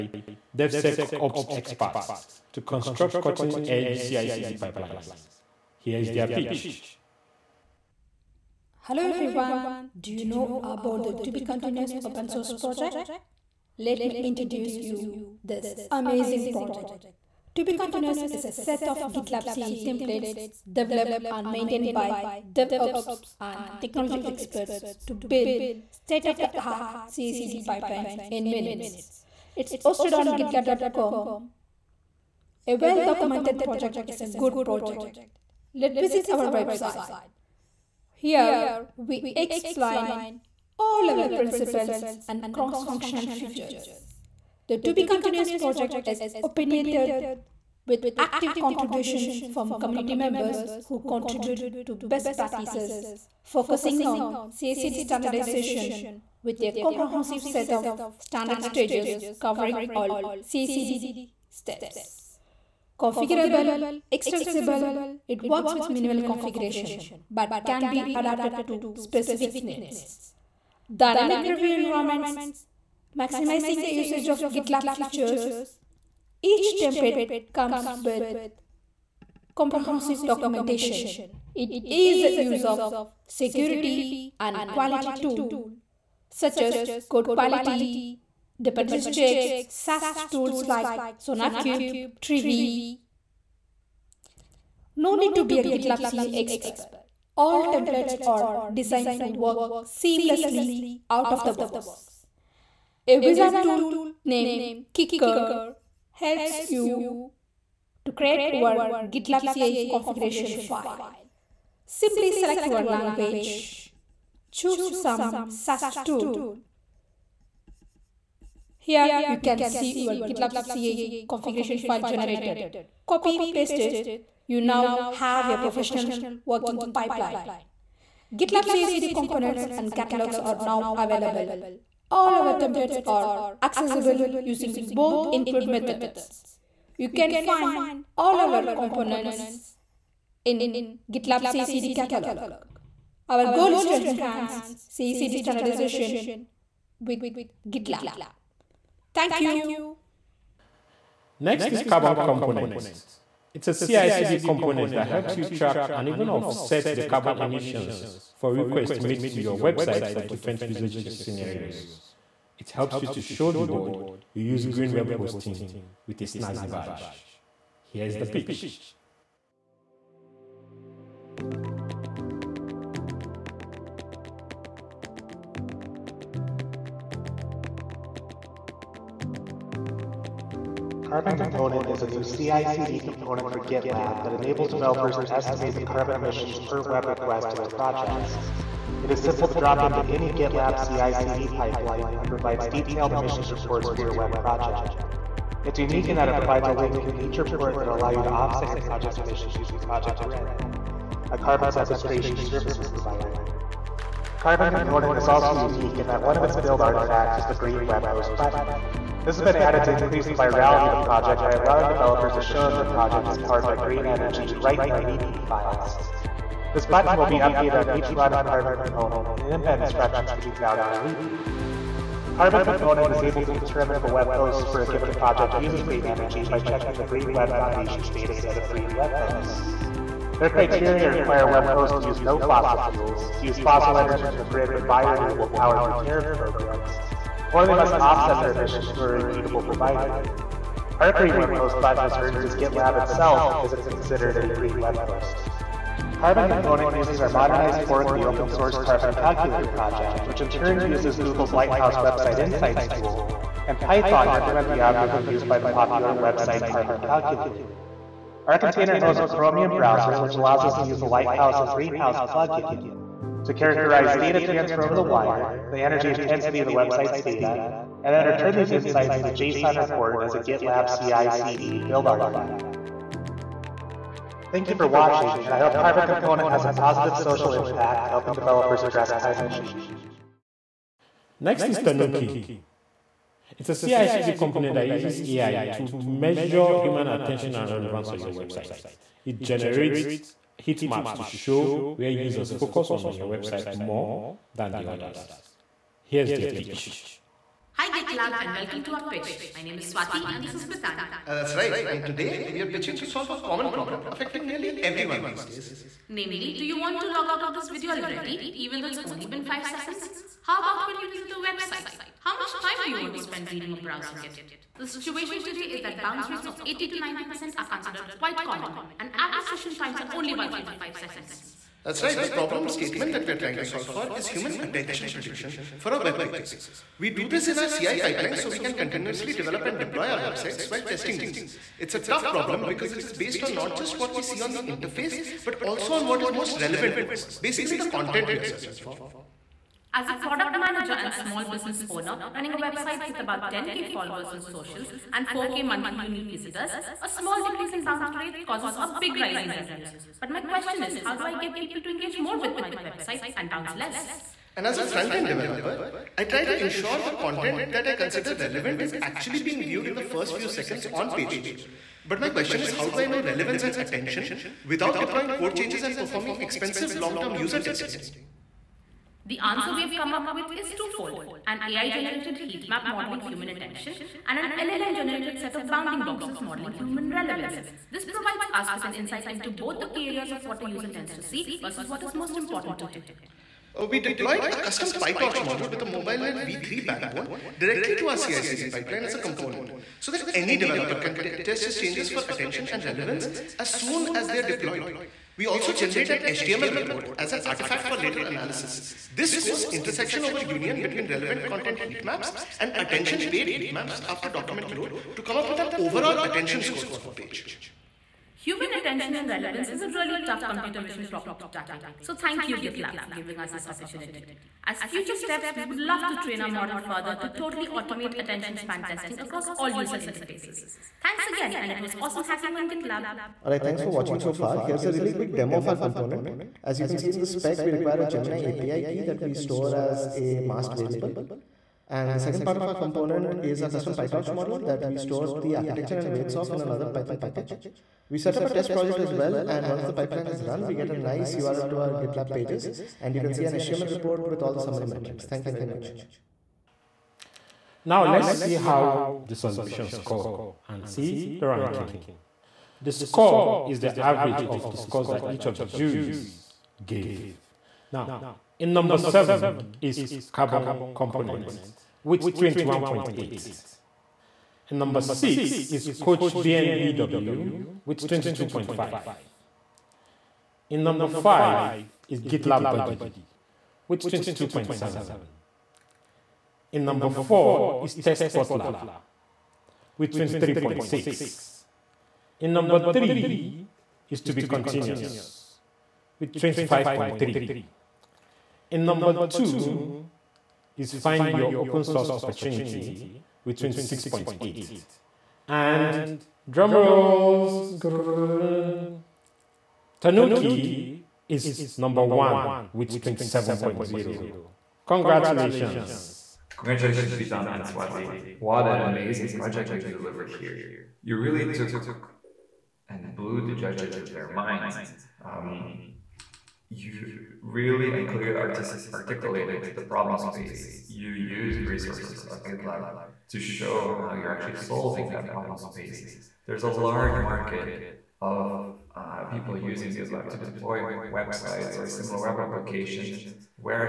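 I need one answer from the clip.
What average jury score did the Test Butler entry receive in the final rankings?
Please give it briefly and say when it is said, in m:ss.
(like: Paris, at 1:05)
23.6, at 8:00.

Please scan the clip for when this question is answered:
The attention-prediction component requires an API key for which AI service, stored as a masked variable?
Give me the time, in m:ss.
7:08.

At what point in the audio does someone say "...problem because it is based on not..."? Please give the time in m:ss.
5:32.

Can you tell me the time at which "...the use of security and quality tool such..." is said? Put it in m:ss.
1:22.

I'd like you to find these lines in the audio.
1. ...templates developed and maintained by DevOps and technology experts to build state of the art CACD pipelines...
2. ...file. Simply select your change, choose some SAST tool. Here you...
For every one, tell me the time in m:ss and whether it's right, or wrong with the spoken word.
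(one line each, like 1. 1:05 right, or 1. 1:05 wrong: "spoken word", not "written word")
1. 0:19 right
2. 1:50 wrong: "language", not "change".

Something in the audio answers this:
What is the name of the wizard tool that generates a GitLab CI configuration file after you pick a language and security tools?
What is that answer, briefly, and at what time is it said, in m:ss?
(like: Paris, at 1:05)
Kicker, at 1:44.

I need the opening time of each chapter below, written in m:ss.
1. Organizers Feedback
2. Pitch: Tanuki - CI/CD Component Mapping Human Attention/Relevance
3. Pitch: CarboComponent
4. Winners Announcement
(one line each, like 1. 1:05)
1. 8:25
2. 4:39
3. 2:29
4. 7:25.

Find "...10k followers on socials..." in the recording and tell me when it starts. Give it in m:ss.
5:43.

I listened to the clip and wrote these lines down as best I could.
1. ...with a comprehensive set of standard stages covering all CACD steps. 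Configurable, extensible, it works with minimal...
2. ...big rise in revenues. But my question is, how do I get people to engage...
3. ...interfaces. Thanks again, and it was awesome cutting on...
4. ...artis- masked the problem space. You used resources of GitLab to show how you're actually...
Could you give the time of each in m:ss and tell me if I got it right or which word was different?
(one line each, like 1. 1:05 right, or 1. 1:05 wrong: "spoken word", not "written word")
1. 0:56 right
2. 5:48 right
3. 6:59 wrong: "hacking", not "cutting"
4. 8:38 wrong: "articulated", not "masked".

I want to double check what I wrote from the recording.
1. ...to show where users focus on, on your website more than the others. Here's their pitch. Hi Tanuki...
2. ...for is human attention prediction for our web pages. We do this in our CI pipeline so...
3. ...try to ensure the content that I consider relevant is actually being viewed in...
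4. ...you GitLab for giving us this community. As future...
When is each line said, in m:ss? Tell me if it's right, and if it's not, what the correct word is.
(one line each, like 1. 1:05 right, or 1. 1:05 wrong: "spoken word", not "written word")
1. 4:51 wrong: "GitLab", not "Tanuki"
2. 5:23 right
3. 5:56 right
4. 6:52 wrong: "opportunity", not "community".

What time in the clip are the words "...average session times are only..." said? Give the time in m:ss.
5:19.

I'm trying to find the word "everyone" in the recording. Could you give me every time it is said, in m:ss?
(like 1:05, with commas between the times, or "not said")
0:09, 5:04.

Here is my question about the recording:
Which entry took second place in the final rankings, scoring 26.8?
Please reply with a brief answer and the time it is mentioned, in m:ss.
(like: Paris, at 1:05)
Find Your Open Source Opportunity, at 8:10.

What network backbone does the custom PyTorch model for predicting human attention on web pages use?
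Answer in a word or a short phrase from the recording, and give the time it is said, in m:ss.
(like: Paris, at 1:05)
MobileNet v3, at 6:25.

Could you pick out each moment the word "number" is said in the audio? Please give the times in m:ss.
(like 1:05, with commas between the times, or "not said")
7:38, 7:44, 7:50, 7:56, 8:02, 8:08, 8:21.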